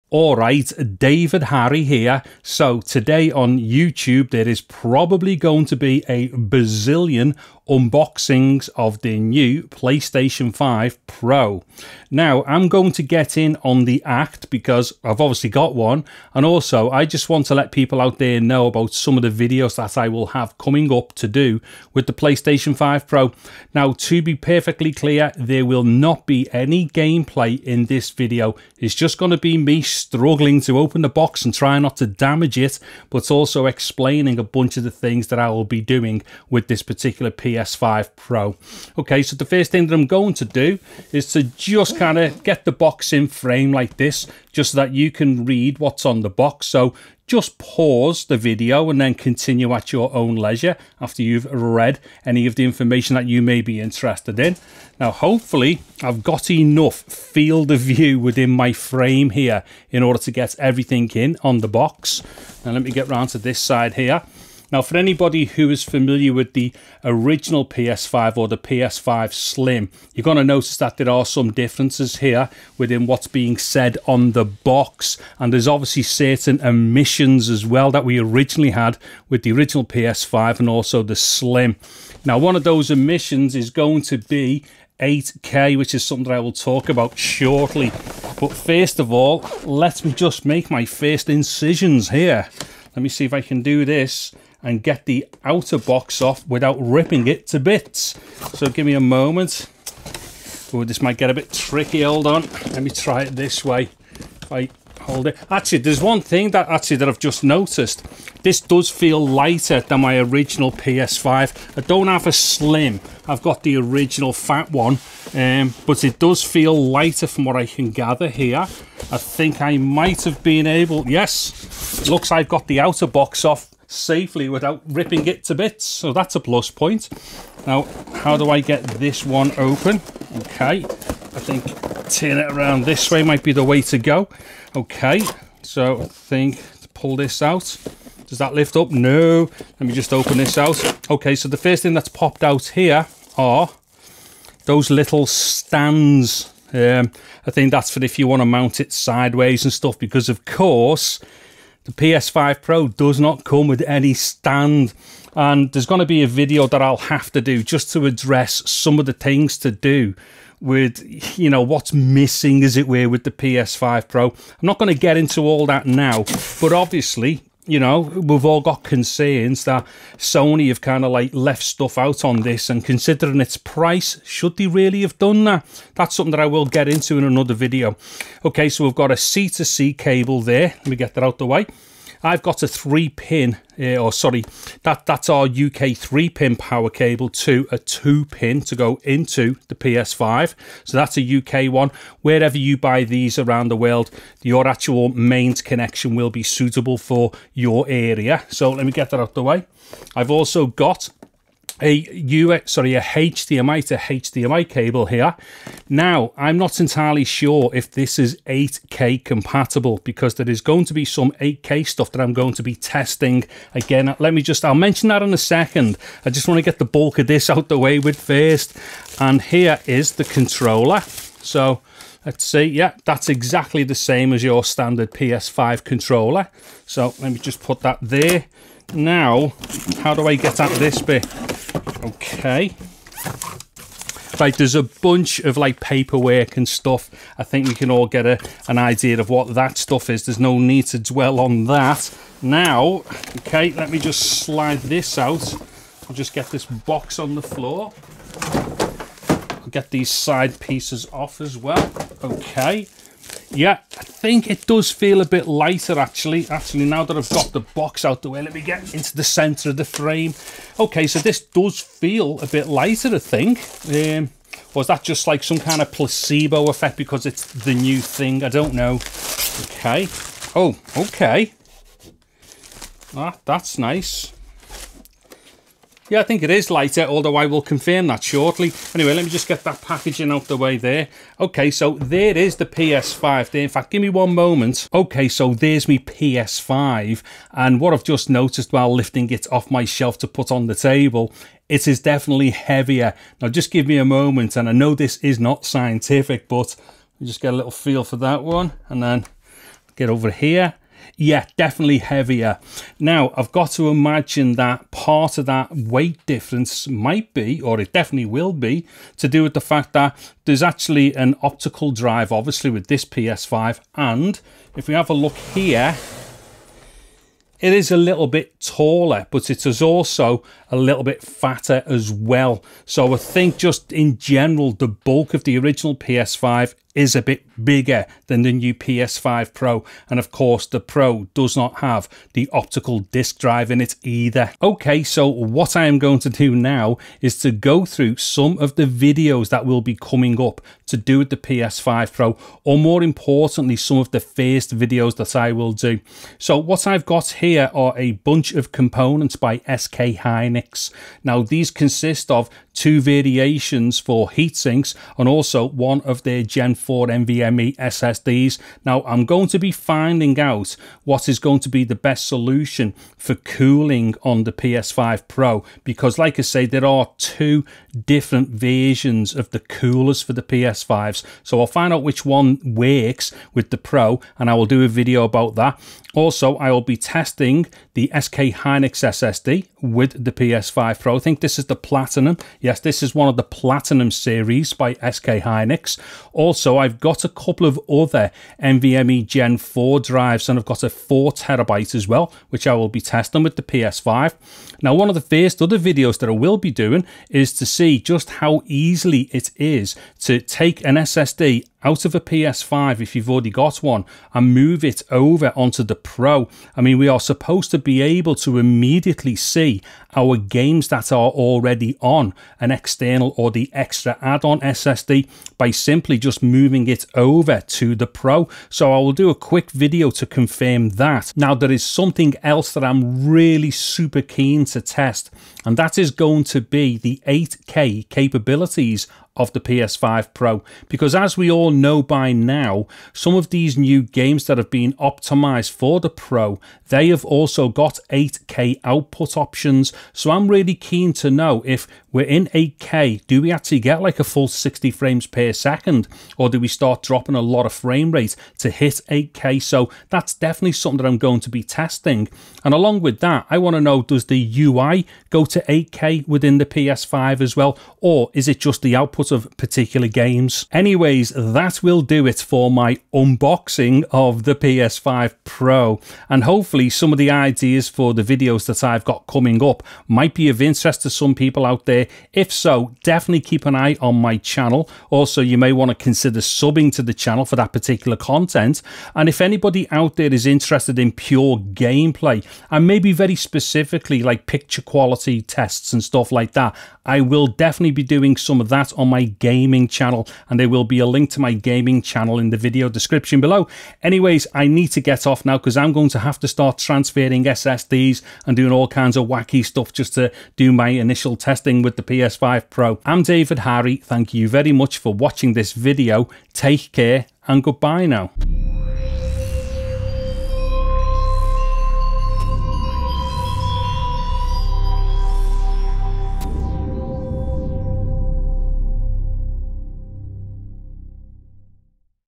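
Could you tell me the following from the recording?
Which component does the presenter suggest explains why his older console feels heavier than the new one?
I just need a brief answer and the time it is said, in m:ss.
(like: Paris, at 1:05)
optical drive, at 5:11.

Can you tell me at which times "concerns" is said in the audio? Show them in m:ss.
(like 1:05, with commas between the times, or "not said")
2:48.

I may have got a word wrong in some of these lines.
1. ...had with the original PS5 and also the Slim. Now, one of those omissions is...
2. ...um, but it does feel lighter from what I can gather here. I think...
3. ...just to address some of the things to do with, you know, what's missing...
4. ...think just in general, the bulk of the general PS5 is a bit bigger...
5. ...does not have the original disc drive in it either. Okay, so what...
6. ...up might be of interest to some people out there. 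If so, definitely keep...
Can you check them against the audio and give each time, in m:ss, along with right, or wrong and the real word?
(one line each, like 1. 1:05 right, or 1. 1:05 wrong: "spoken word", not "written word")
1. 1:18 right
2. 1:55 right
3. 2:37 right
4. 5:23 wrong: "original", not "general"
5. 5:31 wrong: "optical", not "original"
6. 7:49 right.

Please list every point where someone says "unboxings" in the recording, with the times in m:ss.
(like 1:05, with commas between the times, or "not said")
0:07, 7:43.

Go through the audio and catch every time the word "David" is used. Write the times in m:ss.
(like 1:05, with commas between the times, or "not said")
0:00, 8:23.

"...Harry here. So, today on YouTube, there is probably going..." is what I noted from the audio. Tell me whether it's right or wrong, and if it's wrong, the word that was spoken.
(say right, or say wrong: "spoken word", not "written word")
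right.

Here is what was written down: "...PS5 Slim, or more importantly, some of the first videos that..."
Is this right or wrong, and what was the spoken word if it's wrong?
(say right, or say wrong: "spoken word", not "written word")
wrong: "Pro", not "Slim".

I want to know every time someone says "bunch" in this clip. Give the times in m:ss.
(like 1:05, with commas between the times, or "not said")
0:34, 3:54, 5:48.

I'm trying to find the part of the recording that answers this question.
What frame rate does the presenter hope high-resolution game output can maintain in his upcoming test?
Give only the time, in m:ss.
7:24.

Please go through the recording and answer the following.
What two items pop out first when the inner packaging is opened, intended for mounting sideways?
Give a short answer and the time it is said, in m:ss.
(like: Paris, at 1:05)
little stands, at 2:24.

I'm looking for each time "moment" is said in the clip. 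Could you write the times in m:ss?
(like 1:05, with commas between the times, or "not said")
1:38, 4:44, 4:54.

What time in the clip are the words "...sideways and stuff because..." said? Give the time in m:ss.
2:28.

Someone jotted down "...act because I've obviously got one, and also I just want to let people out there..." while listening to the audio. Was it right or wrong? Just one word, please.
right.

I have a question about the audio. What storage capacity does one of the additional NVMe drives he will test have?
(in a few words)
4TB.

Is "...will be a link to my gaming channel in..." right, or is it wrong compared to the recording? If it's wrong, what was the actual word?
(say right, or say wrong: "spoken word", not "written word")
right.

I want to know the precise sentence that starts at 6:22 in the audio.
Yes, this is one of the Platinum series by SK Hynix.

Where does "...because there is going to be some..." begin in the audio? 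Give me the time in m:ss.
3:30.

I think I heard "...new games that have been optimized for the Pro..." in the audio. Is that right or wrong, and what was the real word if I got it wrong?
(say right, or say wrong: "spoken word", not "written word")
right.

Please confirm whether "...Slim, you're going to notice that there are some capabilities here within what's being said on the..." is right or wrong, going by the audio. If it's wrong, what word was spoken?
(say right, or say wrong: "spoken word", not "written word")
wrong: "differences", not "capabilities".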